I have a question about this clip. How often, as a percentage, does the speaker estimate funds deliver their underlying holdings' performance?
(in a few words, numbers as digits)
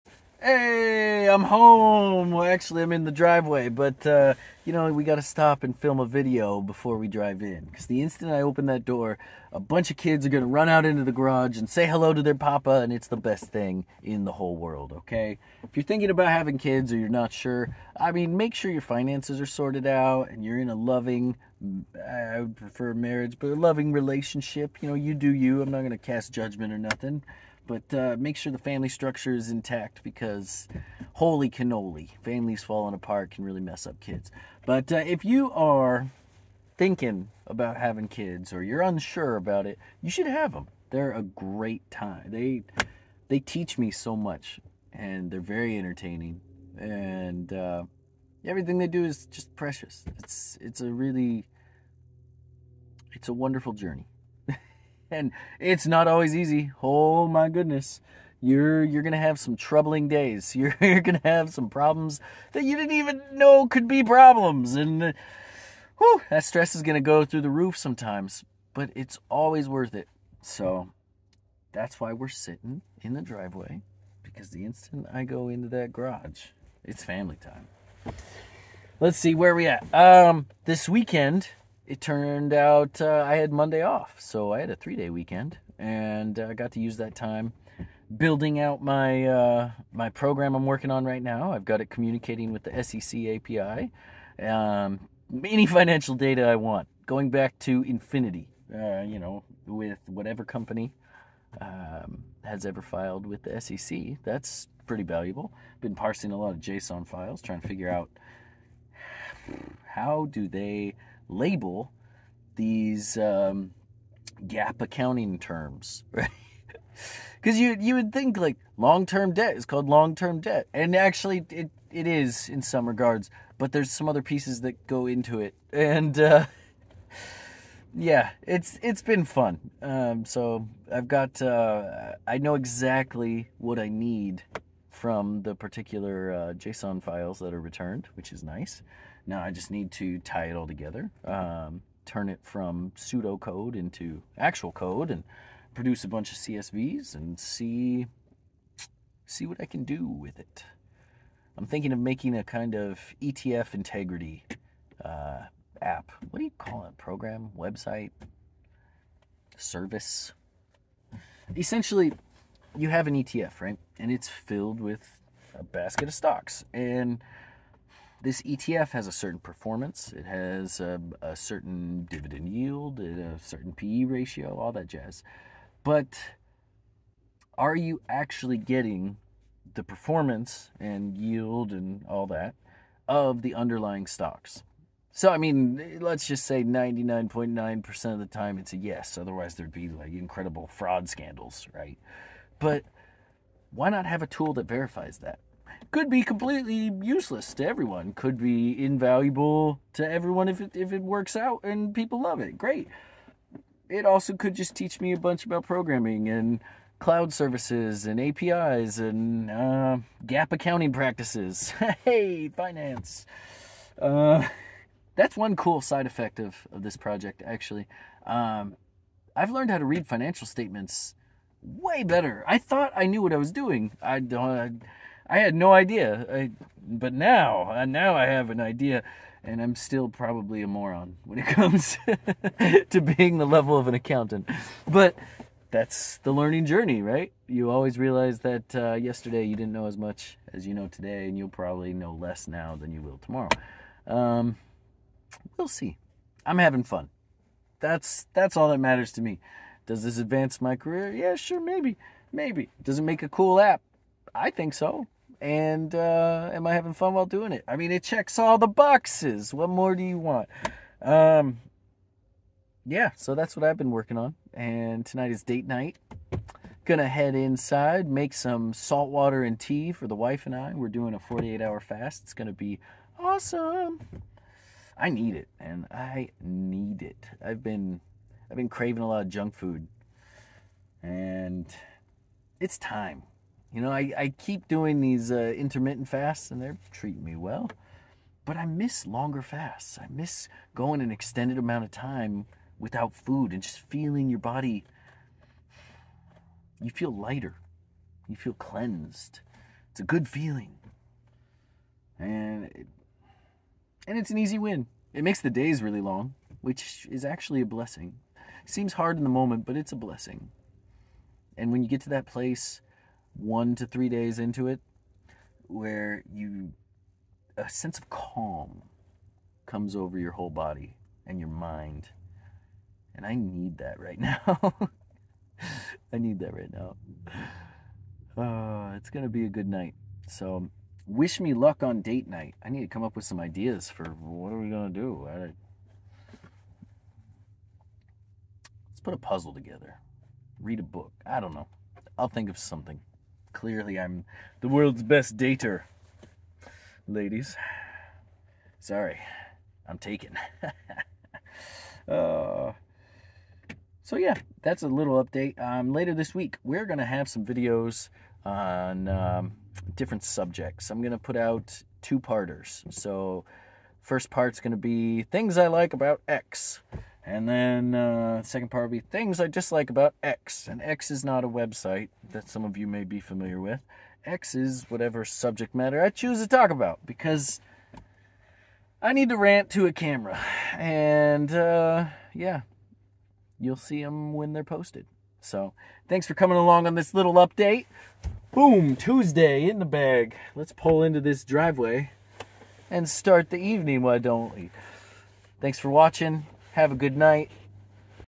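99.9%.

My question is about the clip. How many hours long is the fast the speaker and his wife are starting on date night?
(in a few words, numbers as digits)
48.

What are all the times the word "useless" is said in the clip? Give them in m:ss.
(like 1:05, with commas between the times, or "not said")
3:17.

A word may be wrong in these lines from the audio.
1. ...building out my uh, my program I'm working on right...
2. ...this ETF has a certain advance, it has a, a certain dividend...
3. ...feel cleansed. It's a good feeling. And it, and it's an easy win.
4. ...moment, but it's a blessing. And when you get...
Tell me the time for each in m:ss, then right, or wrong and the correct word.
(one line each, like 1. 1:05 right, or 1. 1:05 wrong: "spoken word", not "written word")
1. 1:28 right
2. 2:48 wrong: "performance", not "advance"
3. 4:58 right
4. 5:09 right.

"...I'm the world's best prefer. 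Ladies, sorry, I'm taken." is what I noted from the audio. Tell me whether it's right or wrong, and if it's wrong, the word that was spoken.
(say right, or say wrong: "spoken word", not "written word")
wrong: "dater", not "prefer".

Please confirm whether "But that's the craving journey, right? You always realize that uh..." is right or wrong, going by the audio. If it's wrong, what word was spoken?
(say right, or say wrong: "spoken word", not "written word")
wrong: "learning", not "craving".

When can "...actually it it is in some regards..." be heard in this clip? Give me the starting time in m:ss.
2:00.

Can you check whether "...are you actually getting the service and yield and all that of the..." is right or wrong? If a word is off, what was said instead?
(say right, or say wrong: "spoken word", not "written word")
wrong: "performance", not "service".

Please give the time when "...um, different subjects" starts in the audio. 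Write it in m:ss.
5:59.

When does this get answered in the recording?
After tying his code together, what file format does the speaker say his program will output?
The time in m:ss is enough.
2:26.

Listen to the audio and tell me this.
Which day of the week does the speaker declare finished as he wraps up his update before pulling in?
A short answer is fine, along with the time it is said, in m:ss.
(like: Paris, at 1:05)
Tuesday, at 6:28.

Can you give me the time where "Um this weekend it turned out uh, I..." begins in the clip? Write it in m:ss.
1:19.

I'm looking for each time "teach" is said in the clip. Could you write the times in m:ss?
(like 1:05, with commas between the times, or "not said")
0:43, 3:24.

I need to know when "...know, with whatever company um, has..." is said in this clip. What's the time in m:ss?
1:39.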